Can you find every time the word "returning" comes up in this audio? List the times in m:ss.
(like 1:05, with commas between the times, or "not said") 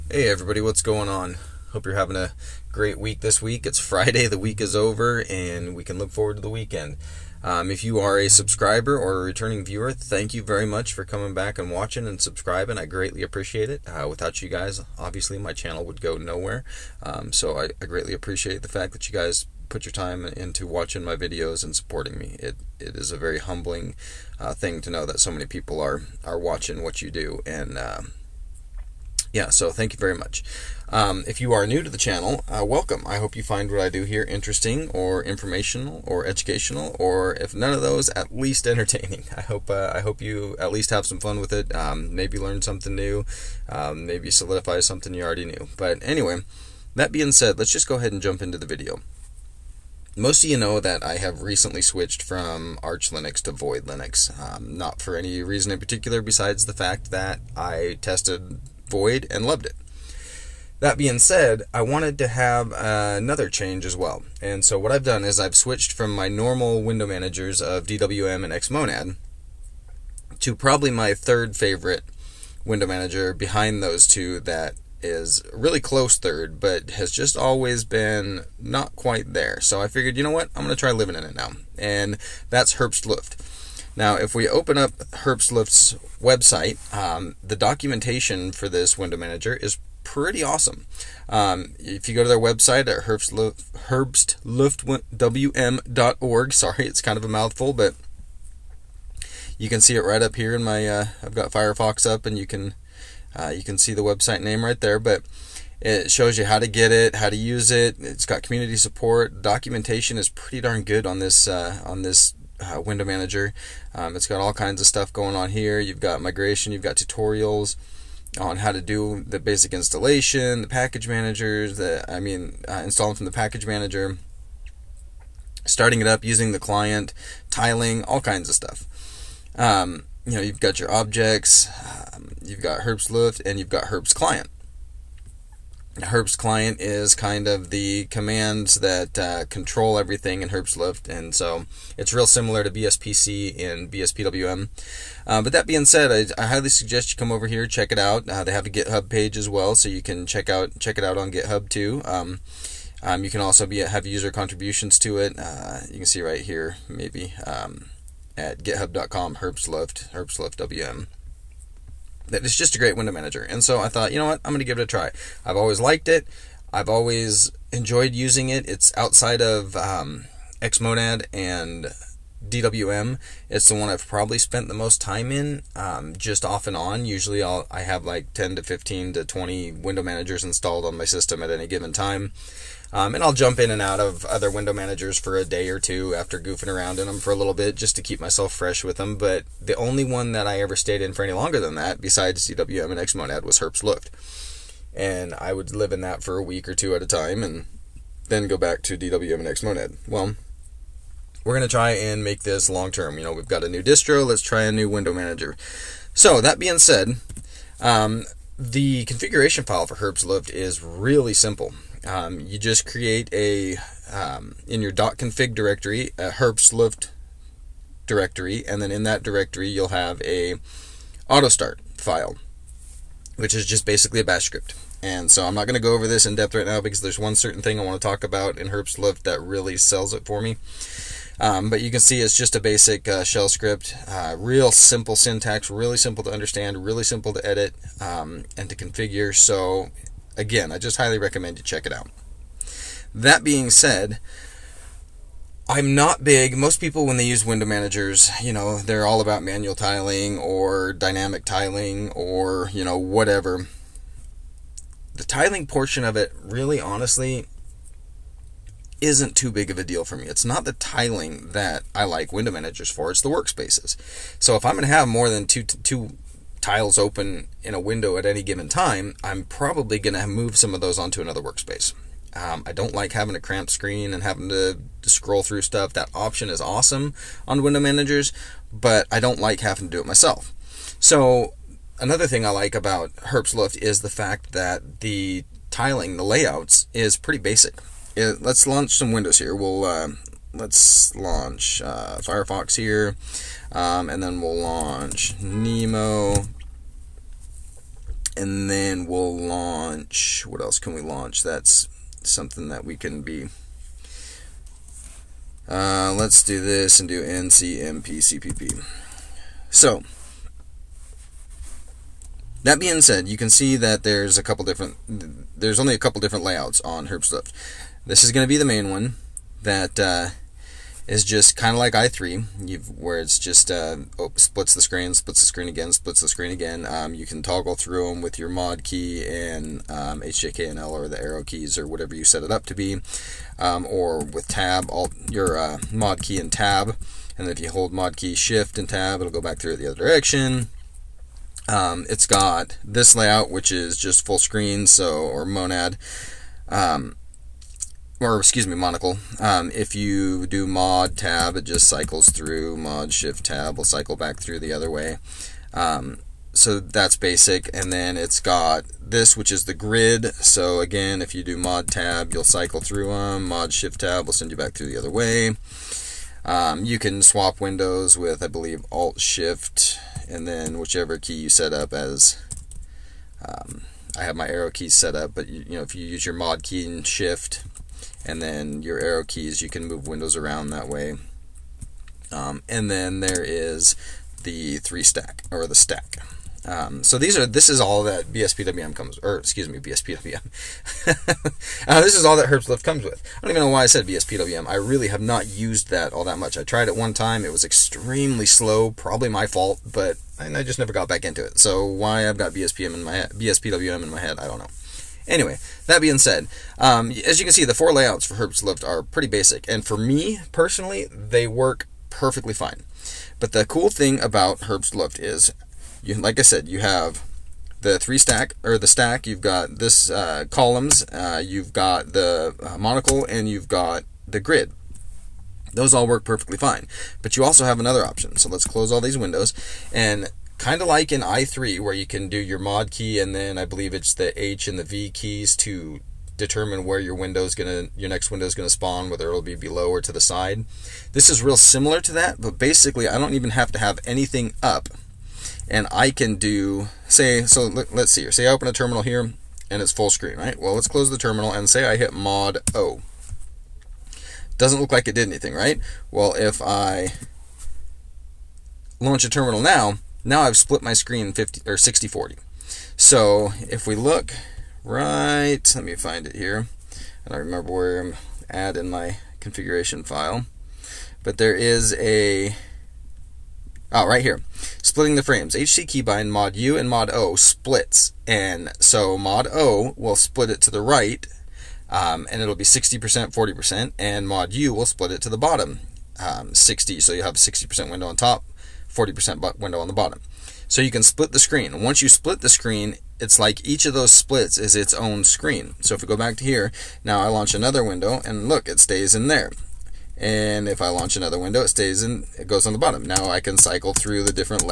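0:09.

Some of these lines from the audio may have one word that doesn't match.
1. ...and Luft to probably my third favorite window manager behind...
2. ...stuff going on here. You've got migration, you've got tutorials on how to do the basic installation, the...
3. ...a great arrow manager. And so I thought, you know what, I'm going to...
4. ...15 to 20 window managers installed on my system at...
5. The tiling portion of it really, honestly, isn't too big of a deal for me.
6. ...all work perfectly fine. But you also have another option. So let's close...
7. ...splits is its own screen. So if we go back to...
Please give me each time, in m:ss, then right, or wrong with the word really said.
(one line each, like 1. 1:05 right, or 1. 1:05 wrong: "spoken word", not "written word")
1. 1:08 wrong: "Xmonad", not "Luft"
2. 1:54 right
3. 2:42 wrong: "window", not "arrow"
4. 2:58 right
5. 4:15 right
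6. 7:05 right
7. 8:14 right.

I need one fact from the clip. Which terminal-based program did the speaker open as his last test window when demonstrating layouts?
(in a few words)
NCMPCPP.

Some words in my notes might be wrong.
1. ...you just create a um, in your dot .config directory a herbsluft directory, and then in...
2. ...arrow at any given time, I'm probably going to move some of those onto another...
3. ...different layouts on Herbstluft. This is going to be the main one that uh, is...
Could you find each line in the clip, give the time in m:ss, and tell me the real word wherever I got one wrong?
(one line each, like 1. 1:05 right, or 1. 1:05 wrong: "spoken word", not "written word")
1. 3:32 right
2. 4:27 wrong: "window", not "arrow"
3. 5:16 right.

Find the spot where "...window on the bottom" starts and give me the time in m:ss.
8:09.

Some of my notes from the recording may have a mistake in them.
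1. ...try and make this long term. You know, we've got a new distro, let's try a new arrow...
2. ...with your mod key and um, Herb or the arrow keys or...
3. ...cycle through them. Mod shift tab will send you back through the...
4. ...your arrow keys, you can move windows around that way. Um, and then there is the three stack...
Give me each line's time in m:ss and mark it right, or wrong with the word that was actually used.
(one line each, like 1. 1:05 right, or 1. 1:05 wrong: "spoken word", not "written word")
1. 3:21 wrong: "window", not "arrow"
2. 5:28 wrong: "HJKNL", not "Herb"
3. 6:02 right
4. 6:18 right.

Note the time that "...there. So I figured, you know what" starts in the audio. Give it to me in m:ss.
1:19.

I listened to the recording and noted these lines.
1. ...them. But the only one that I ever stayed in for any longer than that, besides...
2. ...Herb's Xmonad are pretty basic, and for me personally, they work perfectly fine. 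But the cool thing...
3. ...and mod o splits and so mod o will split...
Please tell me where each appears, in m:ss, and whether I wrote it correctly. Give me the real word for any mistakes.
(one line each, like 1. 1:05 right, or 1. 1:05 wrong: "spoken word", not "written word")
1. 3:08 right
2. 6:48 wrong: "Lift", not "Xmonad"
3. 7:56 right.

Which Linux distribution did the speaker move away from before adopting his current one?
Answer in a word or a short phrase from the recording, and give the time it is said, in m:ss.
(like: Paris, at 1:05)
Arch Linux, at 0:52.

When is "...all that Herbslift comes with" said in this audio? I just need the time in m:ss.
6:32.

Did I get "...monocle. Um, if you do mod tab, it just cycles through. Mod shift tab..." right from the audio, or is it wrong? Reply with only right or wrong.
right.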